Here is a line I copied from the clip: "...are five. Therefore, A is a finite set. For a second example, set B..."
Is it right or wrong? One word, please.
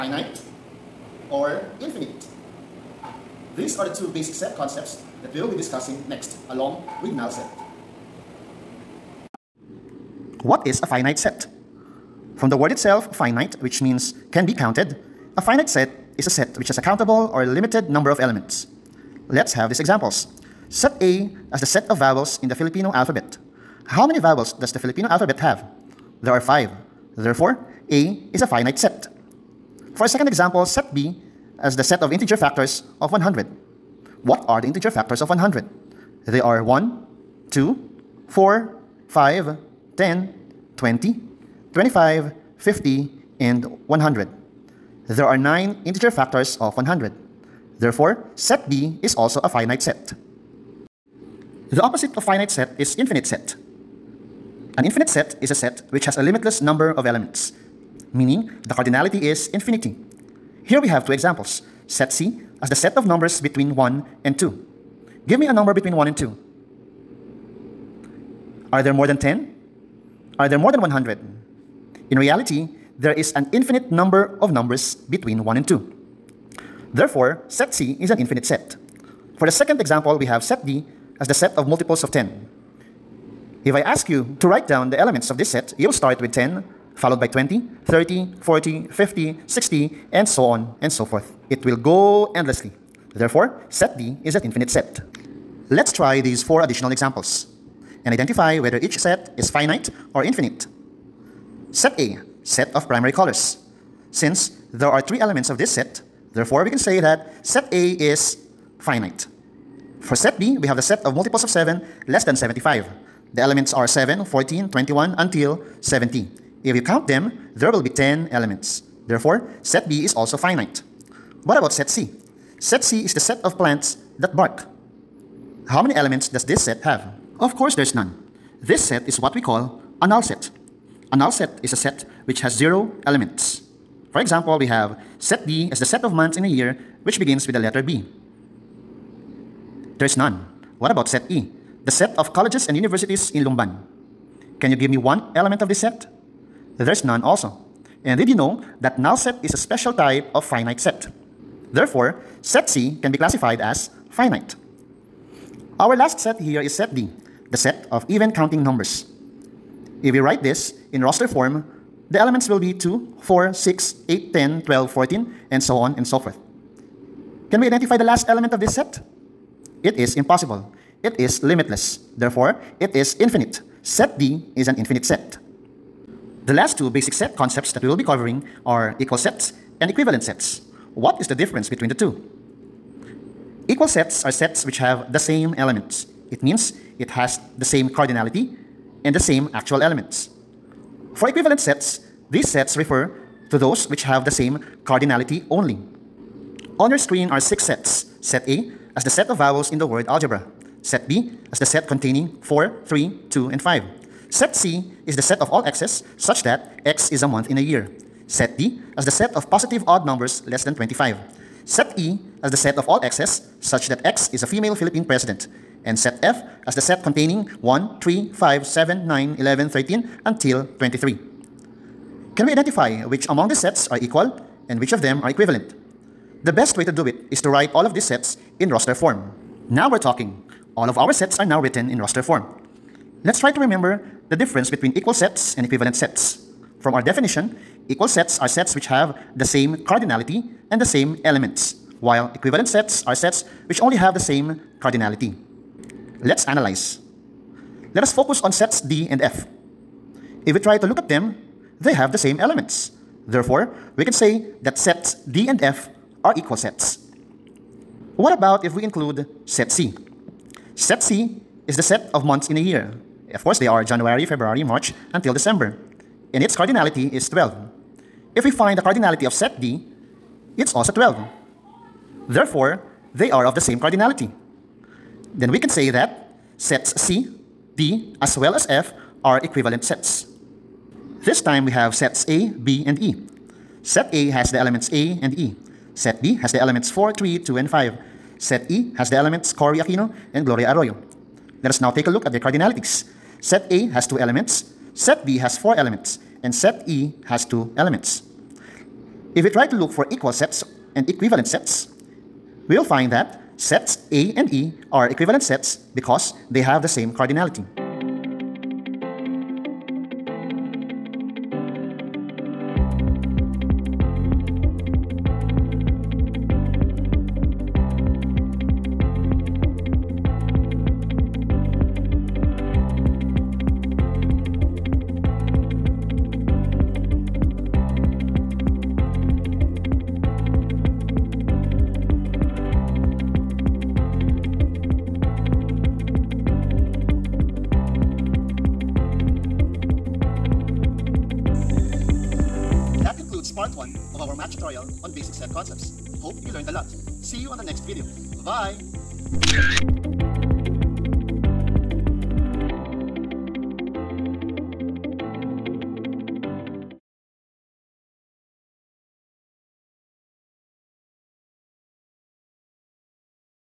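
right.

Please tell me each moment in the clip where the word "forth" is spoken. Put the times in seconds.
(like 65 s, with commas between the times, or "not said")
91 s, 166 s.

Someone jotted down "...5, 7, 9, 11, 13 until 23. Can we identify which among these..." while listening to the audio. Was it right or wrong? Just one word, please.
right.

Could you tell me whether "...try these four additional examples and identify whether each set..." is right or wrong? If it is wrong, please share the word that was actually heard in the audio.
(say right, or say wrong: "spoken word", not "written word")
right.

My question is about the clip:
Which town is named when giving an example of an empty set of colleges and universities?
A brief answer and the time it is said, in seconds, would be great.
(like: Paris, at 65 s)
Lumban, at 143 s.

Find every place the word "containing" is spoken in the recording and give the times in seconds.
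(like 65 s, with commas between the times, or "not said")
201 s, 217 s.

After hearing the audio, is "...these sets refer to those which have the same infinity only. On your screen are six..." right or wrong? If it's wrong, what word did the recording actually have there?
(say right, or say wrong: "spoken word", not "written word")
wrong: "cardinality", not "infinity".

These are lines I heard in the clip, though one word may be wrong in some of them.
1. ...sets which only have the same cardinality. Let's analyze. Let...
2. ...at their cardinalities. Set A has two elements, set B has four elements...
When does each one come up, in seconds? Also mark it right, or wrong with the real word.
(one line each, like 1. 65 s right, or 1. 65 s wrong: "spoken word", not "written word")
1. 243 s right
2. 292 s right.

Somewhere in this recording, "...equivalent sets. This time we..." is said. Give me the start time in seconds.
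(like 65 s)
279 s.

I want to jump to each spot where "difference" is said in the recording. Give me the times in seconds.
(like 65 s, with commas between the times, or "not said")
181 s, 234 s.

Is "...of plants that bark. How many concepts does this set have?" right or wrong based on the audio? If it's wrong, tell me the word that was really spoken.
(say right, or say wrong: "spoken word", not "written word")
wrong: "elements", not "concepts".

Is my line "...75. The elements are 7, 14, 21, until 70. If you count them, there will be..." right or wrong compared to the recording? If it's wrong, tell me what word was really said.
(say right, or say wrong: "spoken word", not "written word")
right.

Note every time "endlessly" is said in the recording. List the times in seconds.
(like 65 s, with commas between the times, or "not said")
92 s.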